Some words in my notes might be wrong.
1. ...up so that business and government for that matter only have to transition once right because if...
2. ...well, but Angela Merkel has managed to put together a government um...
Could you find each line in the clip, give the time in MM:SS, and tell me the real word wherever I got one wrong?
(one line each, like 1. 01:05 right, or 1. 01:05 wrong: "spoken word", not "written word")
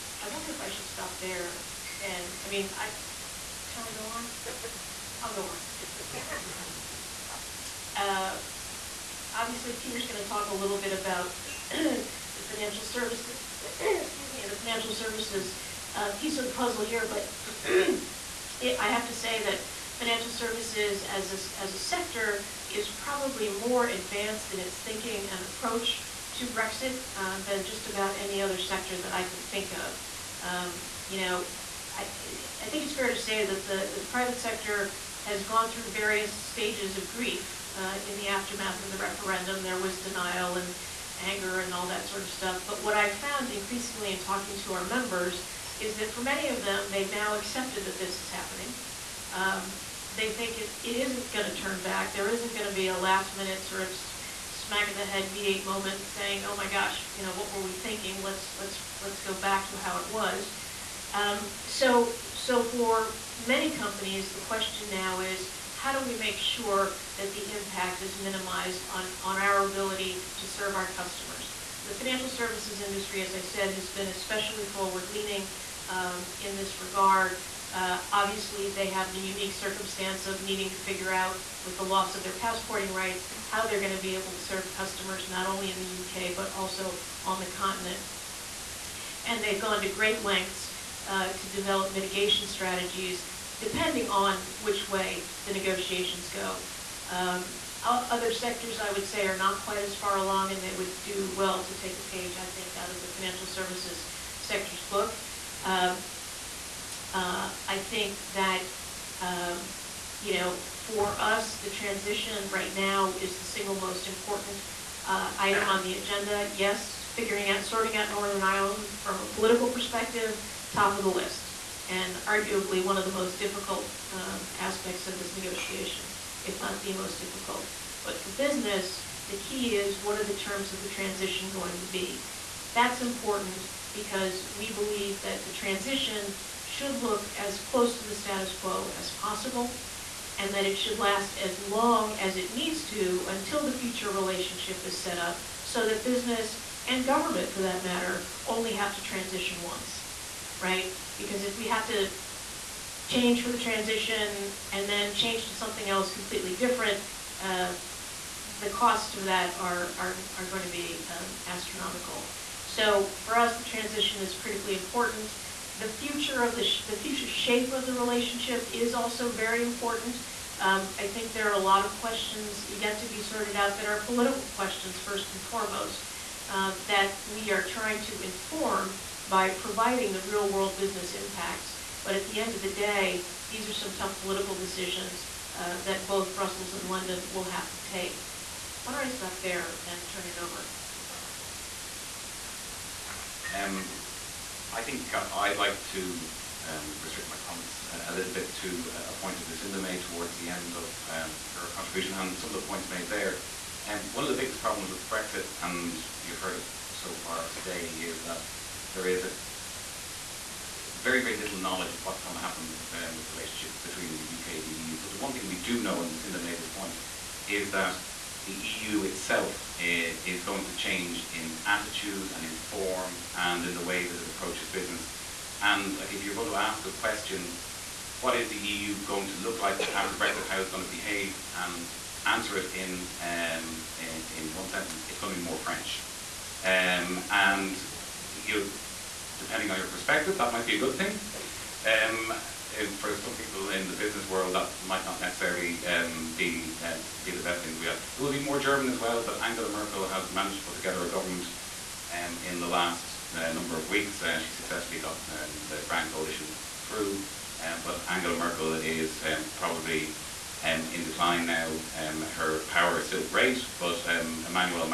1. 02:25 right
2. 04:08 right.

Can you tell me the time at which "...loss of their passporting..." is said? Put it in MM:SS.
01:21.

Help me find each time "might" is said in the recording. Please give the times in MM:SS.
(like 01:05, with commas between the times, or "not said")
04:00, 04:04.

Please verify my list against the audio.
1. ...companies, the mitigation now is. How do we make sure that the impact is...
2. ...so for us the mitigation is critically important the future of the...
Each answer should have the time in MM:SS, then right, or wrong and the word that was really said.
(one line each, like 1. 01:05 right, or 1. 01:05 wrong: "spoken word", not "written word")
1. 01:03 wrong: "question", not "mitigation"
2. 02:42 wrong: "transition", not "mitigation".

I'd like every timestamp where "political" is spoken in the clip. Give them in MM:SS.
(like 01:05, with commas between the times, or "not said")
01:59, 02:54, 03:04.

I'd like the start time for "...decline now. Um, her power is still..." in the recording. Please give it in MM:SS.
04:21.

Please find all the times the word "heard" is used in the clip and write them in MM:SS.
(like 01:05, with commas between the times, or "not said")
03:26.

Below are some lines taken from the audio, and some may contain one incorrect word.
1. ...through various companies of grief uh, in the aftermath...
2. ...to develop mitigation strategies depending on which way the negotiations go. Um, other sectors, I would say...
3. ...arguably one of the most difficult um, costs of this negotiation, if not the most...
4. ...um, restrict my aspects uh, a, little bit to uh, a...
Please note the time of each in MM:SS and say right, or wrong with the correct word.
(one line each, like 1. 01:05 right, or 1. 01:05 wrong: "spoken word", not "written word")
1. 00:35 wrong: "stages", not "companies"
2. 01:31 right
3. 02:02 wrong: "aspects", not "costs"
4. 03:16 wrong: "comments", not "aspects".